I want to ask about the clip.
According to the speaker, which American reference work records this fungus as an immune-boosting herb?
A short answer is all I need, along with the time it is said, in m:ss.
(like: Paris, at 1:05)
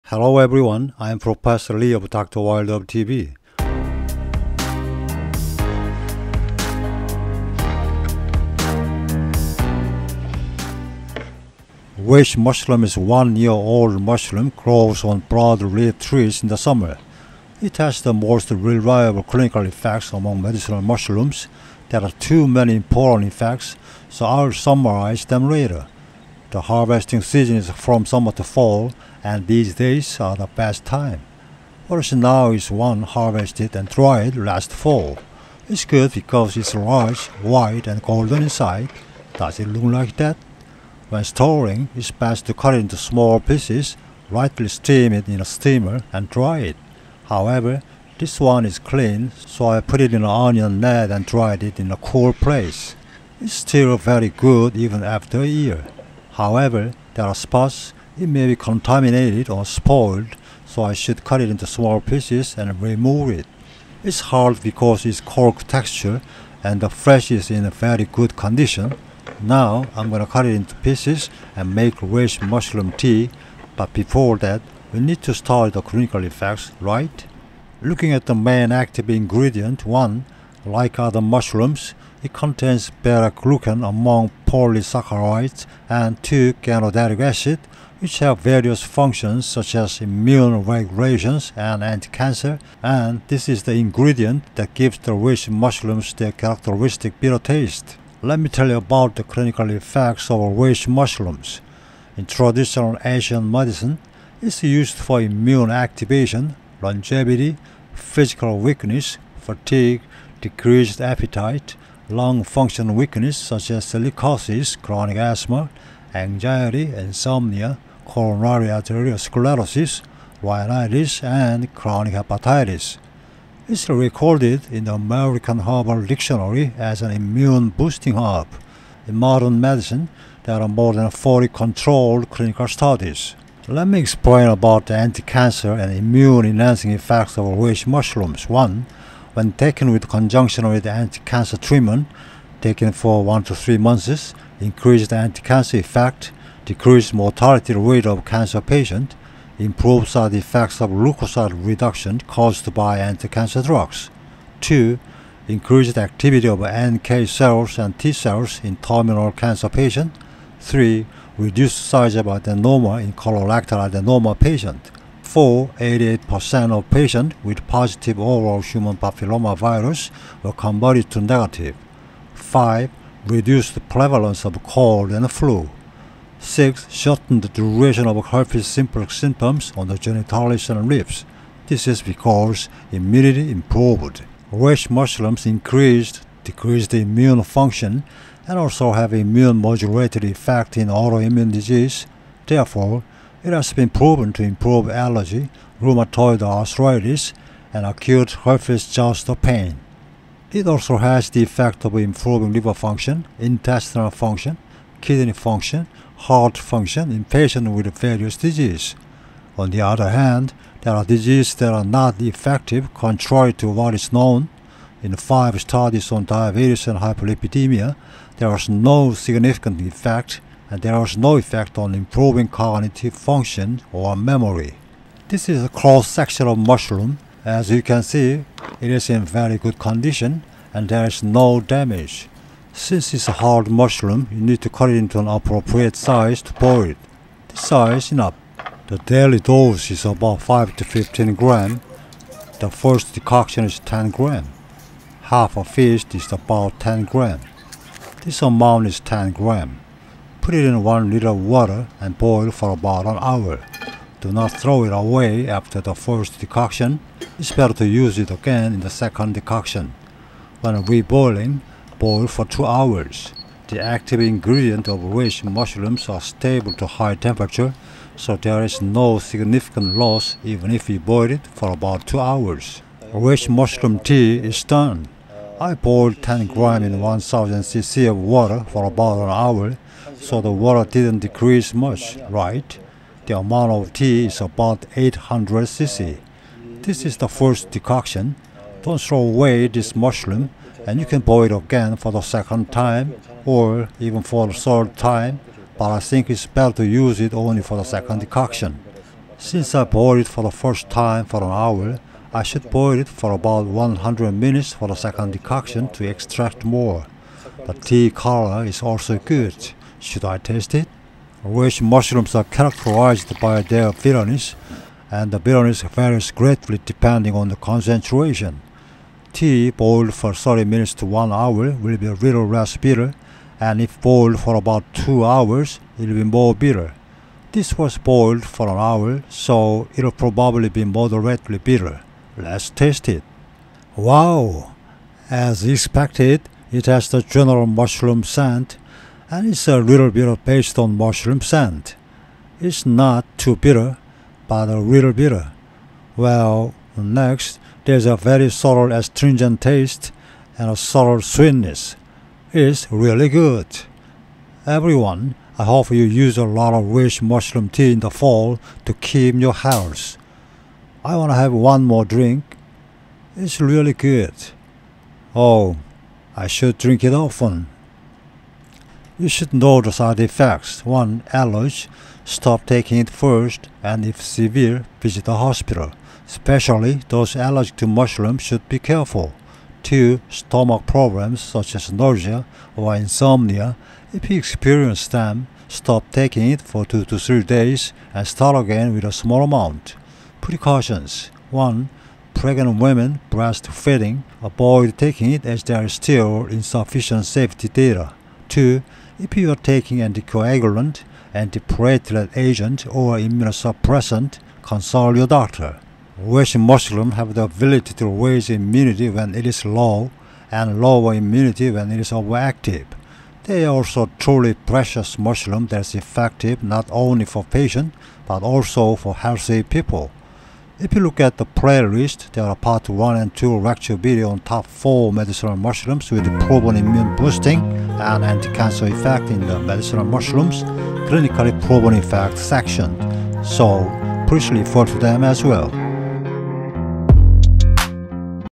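American Herbal Dictionary, at 2:04.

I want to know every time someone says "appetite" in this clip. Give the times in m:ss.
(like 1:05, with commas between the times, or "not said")
1:51.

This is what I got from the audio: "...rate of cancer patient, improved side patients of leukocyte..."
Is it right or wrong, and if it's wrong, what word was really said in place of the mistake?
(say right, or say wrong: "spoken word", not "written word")
wrong: "effects", not "patients".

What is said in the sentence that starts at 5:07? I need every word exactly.
The tea color is also good.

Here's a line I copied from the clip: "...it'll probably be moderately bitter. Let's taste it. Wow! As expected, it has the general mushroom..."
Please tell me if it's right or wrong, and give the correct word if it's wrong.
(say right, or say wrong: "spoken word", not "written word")
right.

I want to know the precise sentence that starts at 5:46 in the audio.
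Well, next, there's a very subtle astringent taste and a subtle sweetness.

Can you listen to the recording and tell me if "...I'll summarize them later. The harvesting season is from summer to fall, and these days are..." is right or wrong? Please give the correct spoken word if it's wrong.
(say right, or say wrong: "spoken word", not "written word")
right.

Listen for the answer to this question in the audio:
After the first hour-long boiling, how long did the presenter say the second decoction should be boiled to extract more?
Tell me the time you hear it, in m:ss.
5:03.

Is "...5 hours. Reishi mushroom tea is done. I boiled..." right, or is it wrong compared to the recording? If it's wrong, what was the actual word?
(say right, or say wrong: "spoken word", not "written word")
wrong: "2", not "5".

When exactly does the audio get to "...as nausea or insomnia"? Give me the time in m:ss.
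6:21.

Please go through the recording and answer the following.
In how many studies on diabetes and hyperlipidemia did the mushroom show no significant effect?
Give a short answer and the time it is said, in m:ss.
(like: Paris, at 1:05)
5, at 3:35.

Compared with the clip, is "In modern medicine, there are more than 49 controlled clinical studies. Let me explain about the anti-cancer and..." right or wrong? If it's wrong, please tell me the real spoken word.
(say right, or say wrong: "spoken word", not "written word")
wrong: "40", not "49".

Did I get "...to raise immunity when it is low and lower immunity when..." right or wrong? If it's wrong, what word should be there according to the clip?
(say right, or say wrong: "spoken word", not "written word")
right.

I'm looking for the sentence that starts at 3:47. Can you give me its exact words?
As you can see, it is in very good condition and there is no damage.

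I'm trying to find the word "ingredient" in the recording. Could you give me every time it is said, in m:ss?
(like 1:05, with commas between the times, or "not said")
1:19, 1:33, 4:24.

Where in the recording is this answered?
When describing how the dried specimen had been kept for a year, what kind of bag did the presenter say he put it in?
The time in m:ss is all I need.
0:50.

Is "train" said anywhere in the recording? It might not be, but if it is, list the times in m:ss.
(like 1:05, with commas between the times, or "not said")
not said.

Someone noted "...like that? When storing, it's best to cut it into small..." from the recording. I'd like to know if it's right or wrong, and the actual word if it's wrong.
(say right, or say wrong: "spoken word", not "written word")
right.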